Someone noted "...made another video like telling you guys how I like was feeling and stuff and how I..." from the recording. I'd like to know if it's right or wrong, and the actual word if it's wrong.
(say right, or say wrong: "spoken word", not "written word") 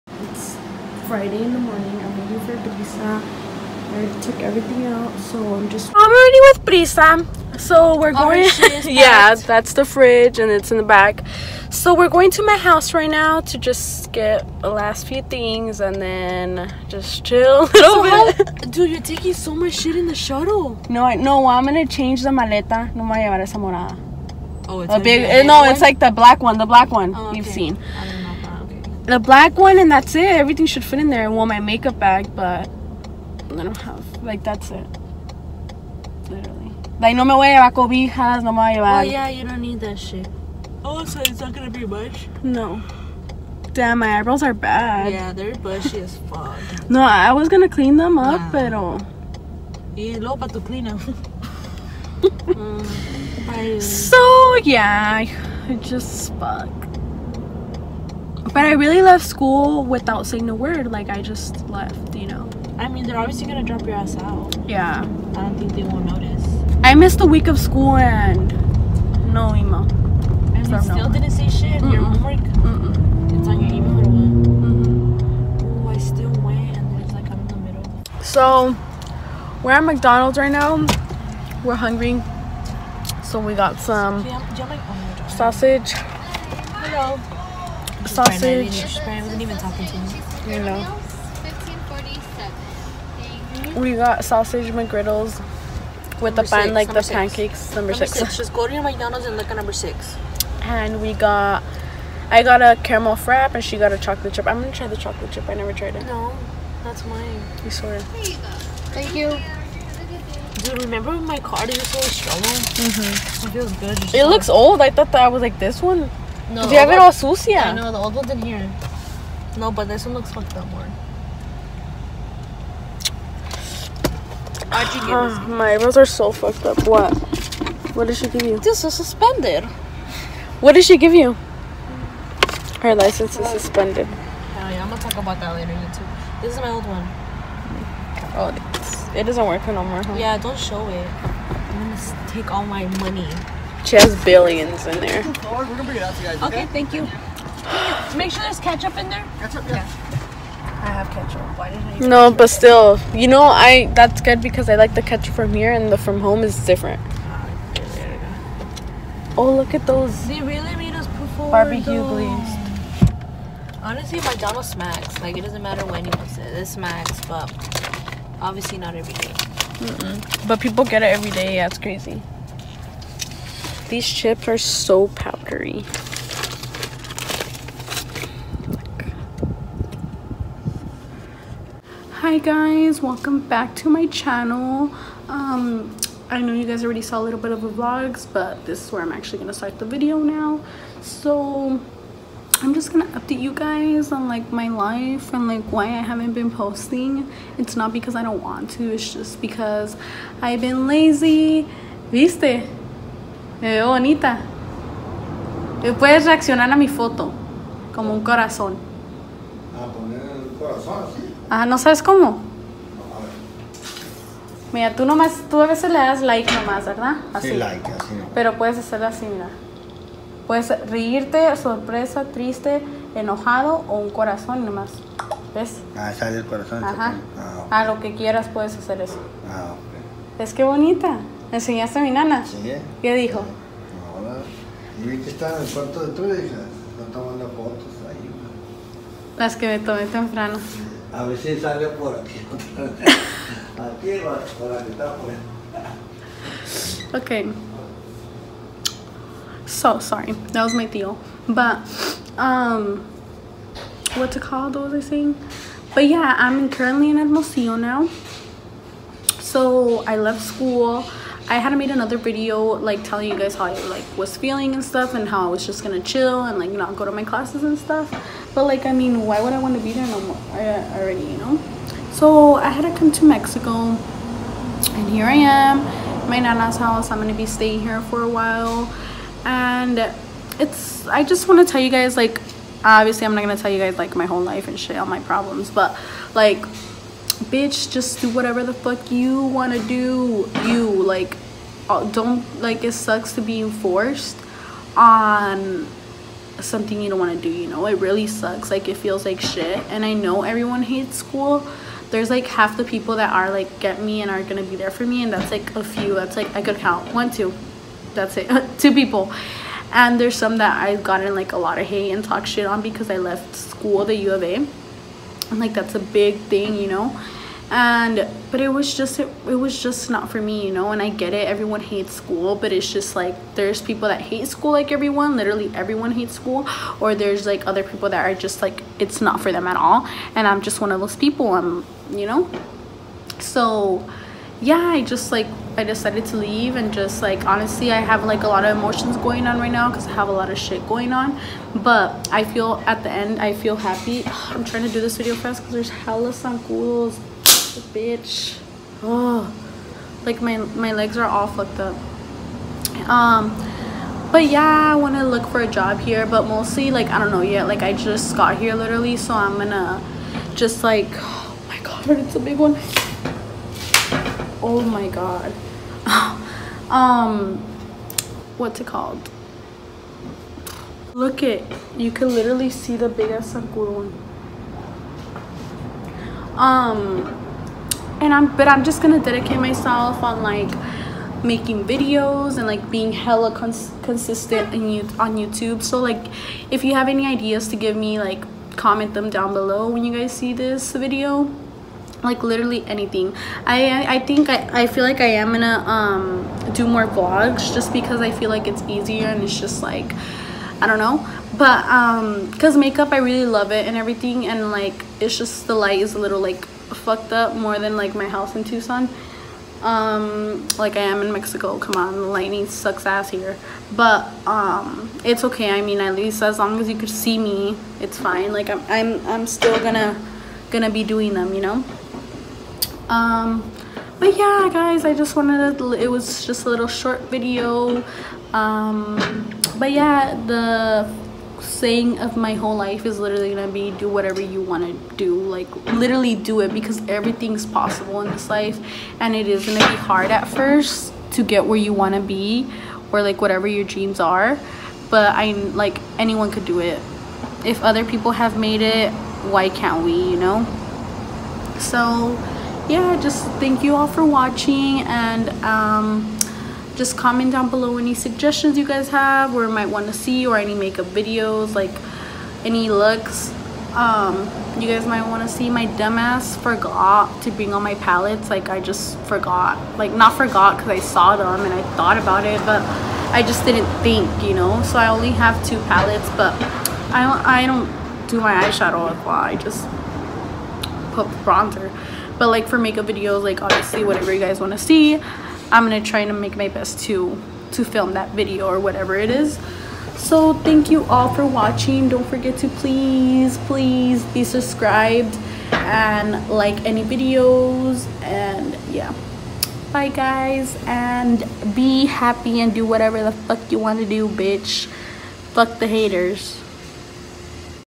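right.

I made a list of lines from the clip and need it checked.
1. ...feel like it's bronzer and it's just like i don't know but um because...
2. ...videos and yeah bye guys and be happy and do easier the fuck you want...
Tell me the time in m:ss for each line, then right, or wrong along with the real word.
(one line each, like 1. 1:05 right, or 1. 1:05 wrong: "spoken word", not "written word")
1. 6:38 wrong: "easier", not "bronzer"
2. 8:17 wrong: "whatever", not "easier".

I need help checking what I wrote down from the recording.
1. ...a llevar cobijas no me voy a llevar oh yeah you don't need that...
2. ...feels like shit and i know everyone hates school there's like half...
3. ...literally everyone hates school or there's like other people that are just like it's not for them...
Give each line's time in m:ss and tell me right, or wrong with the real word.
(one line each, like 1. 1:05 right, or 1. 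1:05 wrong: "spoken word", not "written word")
1. 0:37 right
2. 4:58 right
3. 5:25 right.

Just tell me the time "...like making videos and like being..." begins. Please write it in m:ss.
6:20.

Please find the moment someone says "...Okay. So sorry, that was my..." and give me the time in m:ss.
4:07.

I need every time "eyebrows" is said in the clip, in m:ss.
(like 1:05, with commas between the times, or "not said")
0:44, 2:05.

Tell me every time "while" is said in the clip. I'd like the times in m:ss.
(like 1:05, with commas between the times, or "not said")
4:38.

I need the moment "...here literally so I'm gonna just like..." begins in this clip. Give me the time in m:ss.
5:58.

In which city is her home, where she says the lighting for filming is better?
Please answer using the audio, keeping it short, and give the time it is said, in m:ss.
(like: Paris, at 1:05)
Tucson, at 6:48.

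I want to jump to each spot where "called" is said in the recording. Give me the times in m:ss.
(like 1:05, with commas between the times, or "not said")
4:14, 6:08.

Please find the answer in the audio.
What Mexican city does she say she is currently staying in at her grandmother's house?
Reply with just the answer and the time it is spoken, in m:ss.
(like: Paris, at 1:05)
Hermosillo, at 4:17.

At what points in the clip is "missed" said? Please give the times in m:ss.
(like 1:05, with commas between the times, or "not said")
1:06.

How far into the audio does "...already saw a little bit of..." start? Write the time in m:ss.
3:06.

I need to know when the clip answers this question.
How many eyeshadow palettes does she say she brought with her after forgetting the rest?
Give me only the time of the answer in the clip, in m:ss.
7:55.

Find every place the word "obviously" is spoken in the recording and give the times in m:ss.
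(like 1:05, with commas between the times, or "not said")
1:03, 2:48, 4:42, 8:03.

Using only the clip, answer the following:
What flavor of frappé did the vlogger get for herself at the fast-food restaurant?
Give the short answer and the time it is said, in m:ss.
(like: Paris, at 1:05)
Caramel, at 1:42.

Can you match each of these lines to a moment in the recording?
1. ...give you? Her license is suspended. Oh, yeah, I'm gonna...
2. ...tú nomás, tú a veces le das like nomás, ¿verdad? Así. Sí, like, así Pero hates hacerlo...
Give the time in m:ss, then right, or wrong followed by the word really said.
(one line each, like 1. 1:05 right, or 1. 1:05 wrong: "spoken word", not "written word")
1. 2:10 right
2. 3:34 wrong: "puedes", not "hates".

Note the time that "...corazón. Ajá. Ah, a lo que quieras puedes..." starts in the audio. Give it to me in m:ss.
3:46.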